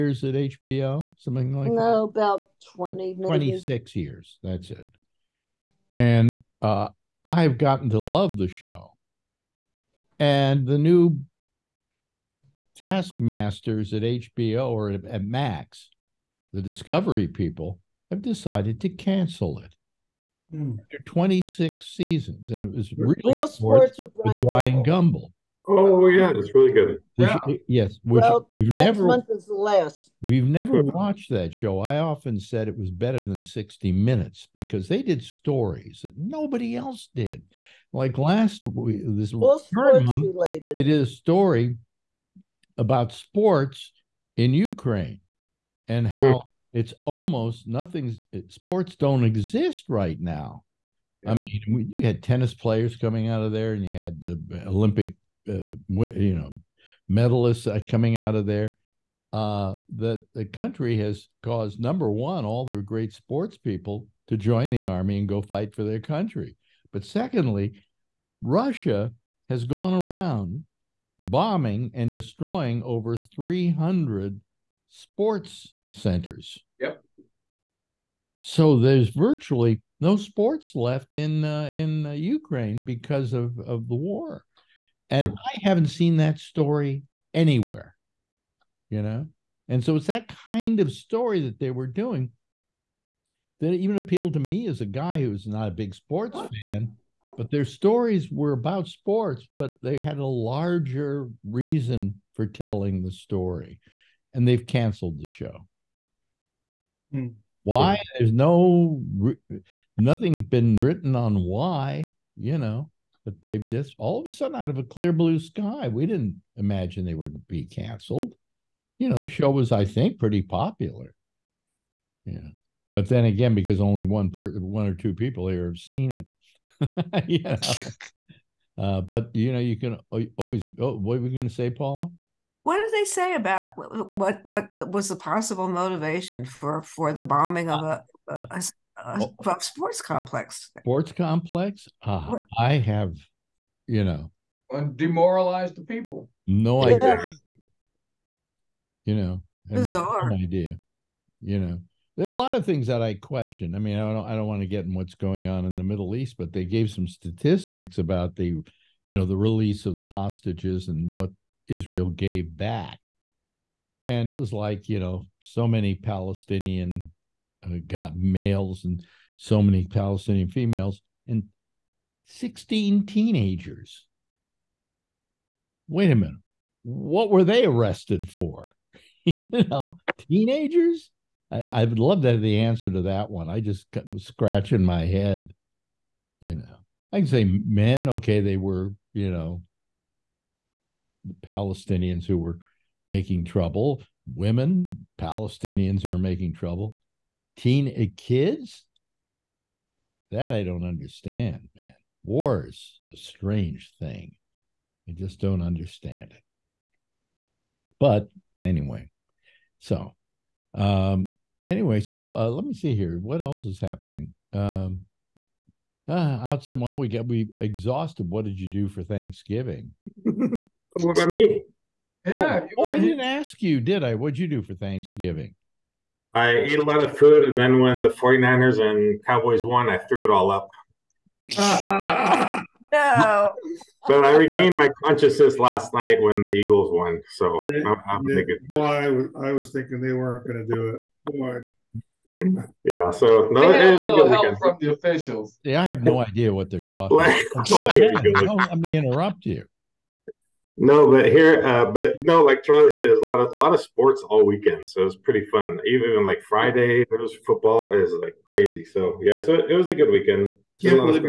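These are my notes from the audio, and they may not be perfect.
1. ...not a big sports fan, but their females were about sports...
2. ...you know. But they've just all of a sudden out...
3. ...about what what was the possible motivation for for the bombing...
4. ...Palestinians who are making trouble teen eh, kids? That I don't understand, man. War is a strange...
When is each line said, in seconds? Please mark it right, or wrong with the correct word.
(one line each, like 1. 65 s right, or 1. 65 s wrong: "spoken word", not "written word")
1. 95 s wrong: "stories", not "females"
2. 112 s right
3. 133 s right
4. 195 s right.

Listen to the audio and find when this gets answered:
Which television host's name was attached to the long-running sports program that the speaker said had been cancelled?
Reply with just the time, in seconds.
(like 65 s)
24 s.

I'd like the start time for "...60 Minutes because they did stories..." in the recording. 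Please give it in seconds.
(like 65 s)
33 s.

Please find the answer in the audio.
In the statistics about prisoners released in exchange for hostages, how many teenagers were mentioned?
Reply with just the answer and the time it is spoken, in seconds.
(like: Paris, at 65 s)
16, at 172 s.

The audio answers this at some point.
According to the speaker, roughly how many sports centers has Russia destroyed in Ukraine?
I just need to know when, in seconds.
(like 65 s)
73 s.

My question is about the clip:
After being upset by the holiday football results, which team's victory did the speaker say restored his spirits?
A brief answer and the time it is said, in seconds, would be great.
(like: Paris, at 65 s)
Eagles, at 236 s.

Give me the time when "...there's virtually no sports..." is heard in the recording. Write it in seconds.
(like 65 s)
78 s.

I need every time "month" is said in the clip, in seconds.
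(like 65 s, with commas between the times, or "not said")
29 s, 40 s.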